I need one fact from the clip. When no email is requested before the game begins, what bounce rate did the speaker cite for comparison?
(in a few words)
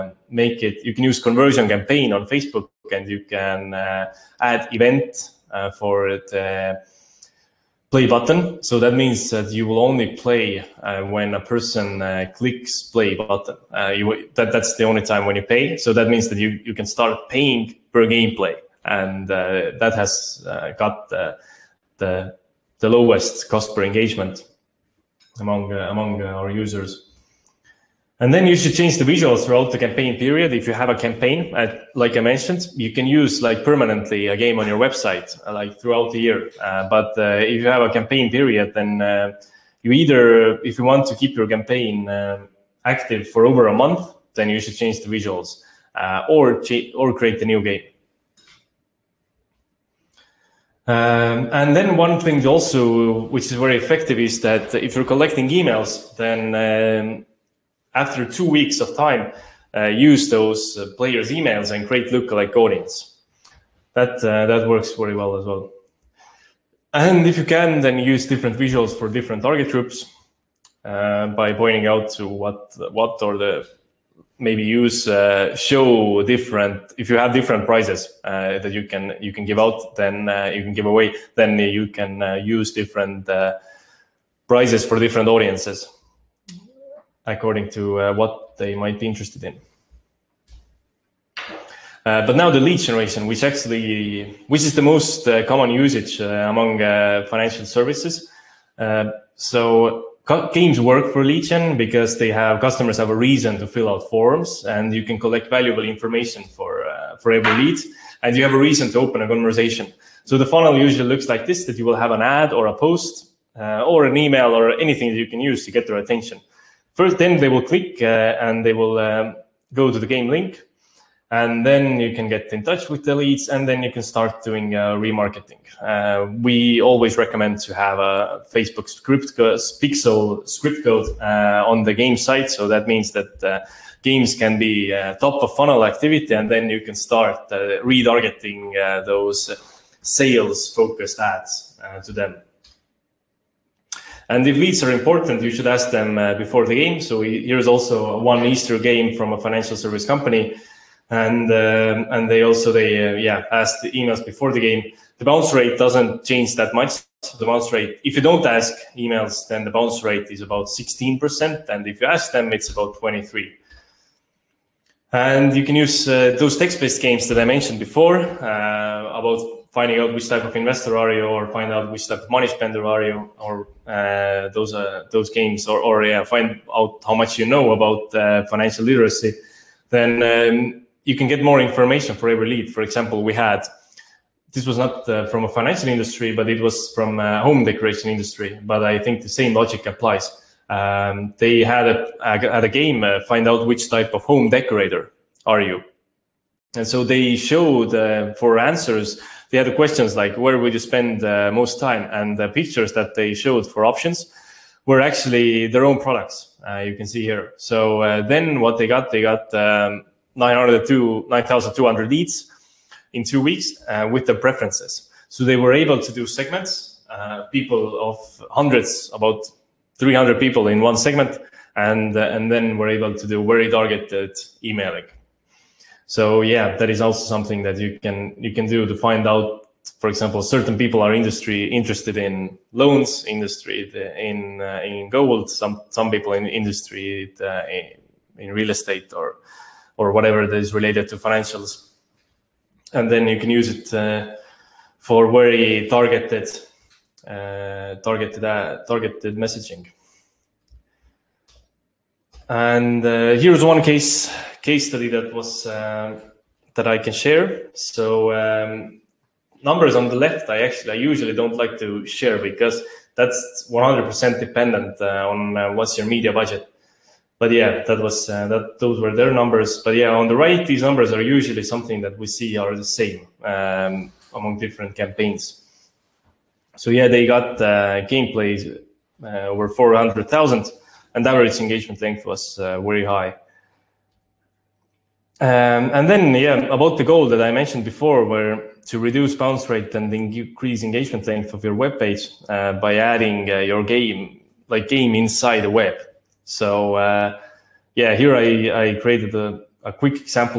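16%.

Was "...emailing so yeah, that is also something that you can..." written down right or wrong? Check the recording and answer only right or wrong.
right.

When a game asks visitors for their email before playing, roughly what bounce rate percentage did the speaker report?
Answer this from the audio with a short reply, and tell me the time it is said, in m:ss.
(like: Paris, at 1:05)
23%, at 2:42.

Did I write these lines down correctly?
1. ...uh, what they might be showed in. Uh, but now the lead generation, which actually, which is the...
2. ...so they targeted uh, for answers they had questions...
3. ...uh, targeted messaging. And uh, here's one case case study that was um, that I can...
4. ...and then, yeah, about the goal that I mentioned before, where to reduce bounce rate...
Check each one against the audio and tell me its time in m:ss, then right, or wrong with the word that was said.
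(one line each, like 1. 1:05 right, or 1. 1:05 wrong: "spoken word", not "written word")
1. 1:27 wrong: "interested", not "showed"
2. 3:16 wrong: "showed", not "targeted"
3. 4:08 right
4. 4:45 right.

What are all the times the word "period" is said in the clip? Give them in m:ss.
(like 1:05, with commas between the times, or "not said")
0:30, 0:38.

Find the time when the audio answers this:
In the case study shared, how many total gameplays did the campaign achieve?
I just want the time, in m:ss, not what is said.
4:39.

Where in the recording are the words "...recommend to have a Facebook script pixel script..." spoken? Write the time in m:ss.
2:07.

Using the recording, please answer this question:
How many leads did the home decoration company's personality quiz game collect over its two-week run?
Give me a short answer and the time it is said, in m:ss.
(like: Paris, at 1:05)
9200, at 3:30.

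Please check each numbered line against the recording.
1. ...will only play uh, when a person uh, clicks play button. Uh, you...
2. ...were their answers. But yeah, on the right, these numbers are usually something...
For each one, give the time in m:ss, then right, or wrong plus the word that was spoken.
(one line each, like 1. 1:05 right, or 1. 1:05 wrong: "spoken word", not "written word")
1. 0:09 right
2. 4:28 wrong: "numbers", not "answers".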